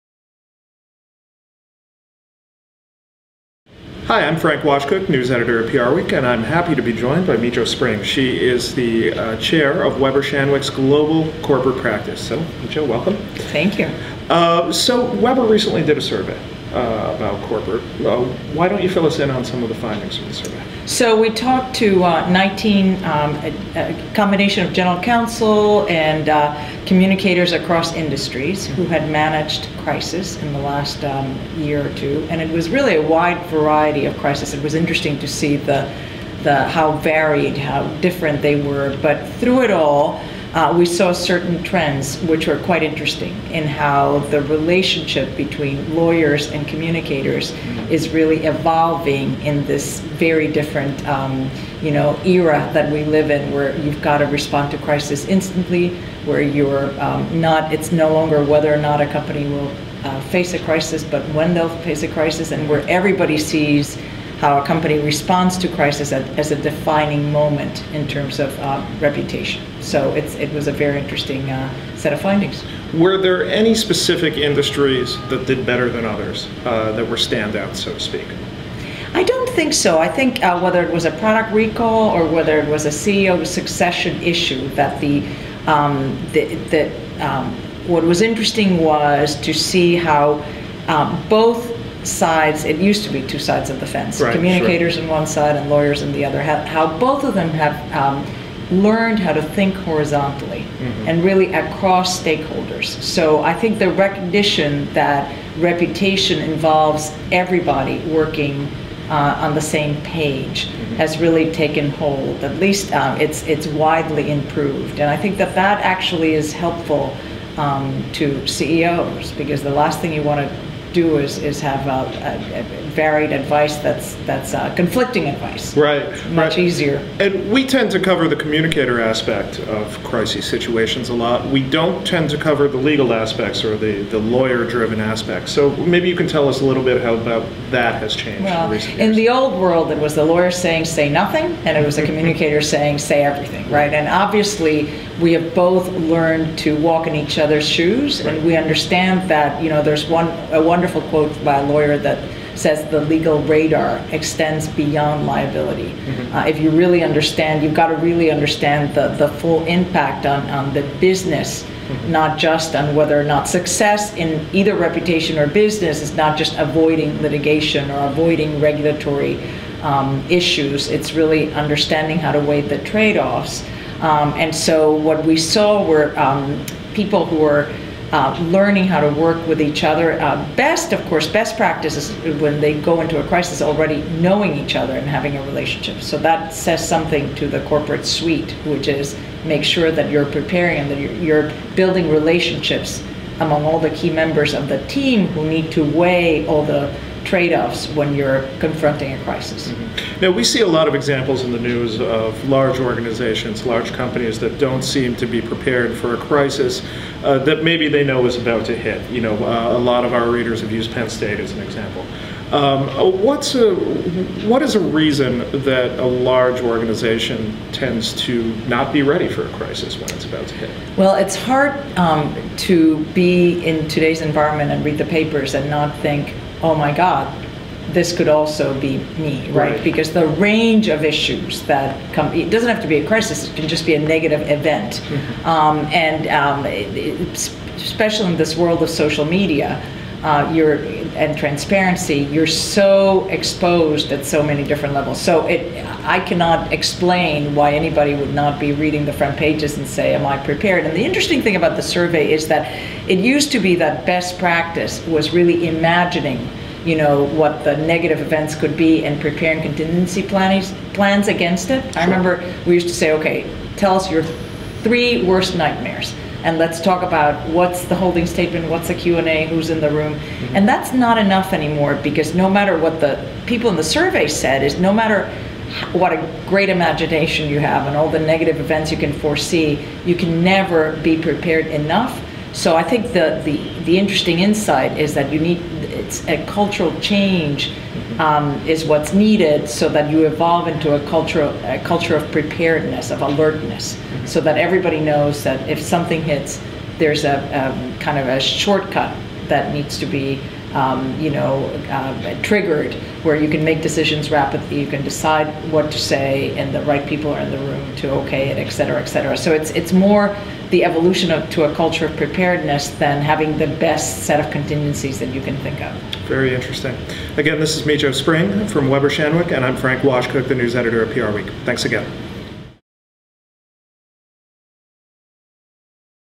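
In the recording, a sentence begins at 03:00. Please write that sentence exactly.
Uh, best, of course, best practice is when they go into a crisis already knowing each other and having a relationship.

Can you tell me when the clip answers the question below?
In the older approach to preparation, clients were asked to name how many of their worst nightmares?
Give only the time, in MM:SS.
04:24.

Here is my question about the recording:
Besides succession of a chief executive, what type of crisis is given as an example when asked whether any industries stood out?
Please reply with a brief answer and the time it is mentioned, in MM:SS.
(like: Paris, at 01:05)
product recall, at 01:21.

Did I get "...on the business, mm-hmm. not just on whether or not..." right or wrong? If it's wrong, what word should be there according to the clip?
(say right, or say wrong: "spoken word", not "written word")
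right.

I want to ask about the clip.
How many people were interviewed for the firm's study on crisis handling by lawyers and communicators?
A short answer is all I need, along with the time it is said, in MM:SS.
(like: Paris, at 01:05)
19, at 00:22.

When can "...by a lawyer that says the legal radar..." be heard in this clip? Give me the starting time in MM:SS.
02:31.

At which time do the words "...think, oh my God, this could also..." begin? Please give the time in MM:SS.
03:45.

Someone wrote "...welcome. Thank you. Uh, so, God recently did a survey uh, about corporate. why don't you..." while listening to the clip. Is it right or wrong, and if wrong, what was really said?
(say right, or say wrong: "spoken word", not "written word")
wrong: "Weber", not "God".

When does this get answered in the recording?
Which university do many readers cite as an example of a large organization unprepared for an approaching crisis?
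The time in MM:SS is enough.
03:30.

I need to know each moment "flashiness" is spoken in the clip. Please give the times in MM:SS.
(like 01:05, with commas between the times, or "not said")
not said.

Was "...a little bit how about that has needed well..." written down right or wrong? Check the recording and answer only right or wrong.
wrong.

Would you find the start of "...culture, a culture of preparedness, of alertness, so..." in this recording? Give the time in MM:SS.
04:51.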